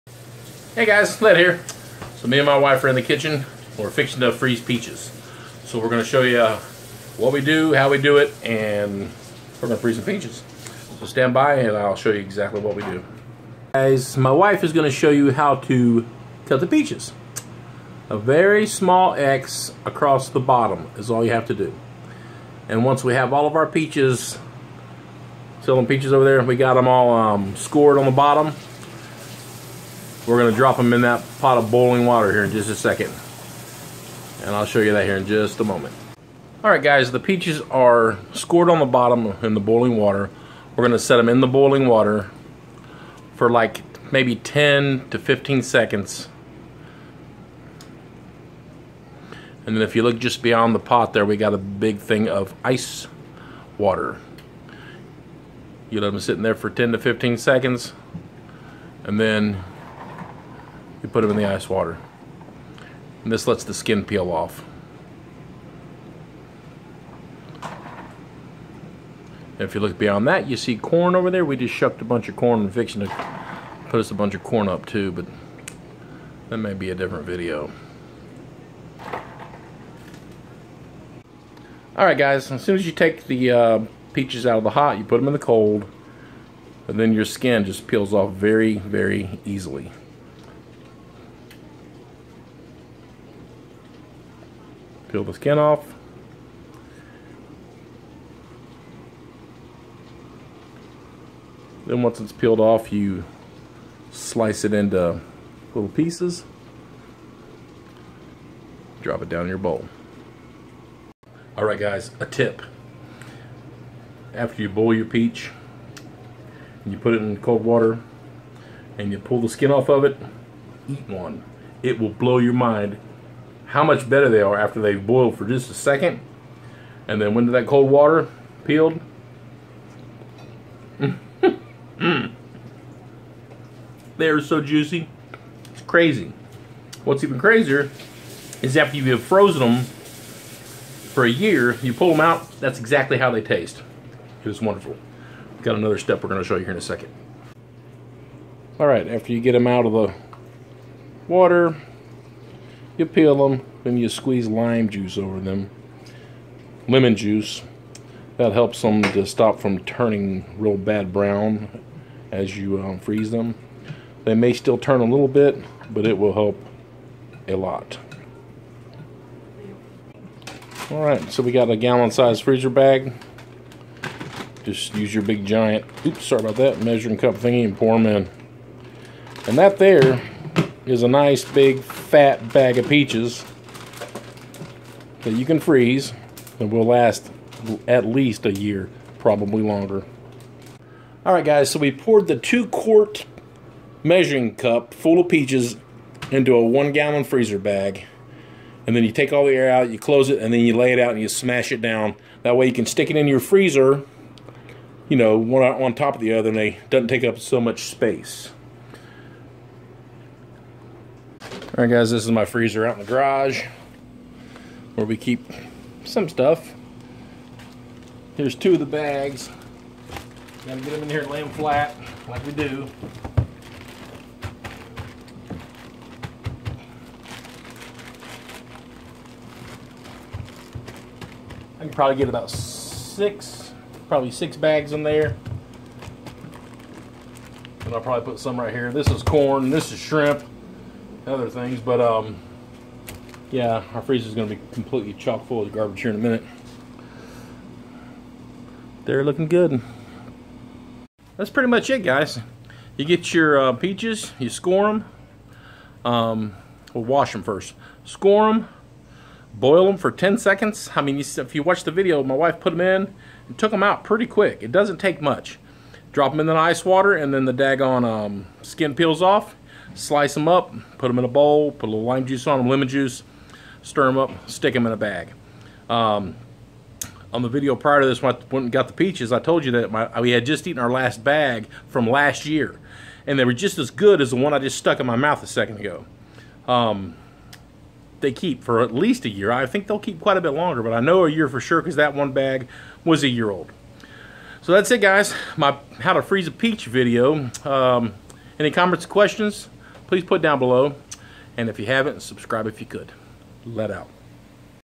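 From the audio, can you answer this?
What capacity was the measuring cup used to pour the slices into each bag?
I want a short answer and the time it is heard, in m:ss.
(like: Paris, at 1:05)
2 quart, at 3:12.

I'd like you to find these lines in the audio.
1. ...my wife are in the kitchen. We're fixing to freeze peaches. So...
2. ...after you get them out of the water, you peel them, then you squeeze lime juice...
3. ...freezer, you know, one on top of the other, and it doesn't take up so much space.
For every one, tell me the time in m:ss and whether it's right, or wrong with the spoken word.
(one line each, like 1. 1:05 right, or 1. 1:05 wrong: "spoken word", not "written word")
1. 0:02 right
2. 2:29 right
3. 3:23 right.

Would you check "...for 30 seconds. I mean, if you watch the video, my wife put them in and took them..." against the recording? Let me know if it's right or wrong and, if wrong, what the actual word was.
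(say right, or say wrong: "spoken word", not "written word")
wrong: "10", not "30".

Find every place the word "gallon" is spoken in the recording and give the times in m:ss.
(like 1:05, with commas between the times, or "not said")
2:51, 3:16.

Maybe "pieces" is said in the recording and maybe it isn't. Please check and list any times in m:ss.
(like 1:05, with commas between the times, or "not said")
1:45.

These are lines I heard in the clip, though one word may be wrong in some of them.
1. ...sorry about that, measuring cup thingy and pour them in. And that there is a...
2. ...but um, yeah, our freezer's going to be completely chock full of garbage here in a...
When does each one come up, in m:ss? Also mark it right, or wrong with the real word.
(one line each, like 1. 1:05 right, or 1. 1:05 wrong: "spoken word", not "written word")
1. 2:56 right
2. 4:01 right.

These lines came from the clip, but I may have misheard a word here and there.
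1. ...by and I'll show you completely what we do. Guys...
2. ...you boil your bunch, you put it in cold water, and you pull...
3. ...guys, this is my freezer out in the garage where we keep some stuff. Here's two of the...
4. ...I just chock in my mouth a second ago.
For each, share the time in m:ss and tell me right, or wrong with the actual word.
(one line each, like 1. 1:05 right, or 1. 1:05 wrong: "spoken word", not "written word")
1. 0:11 wrong: "exactly", not "completely"
2. 1:54 wrong: "peach", not "bunch"
3. 3:31 right
4. 4:44 wrong: "stuck", not "chock".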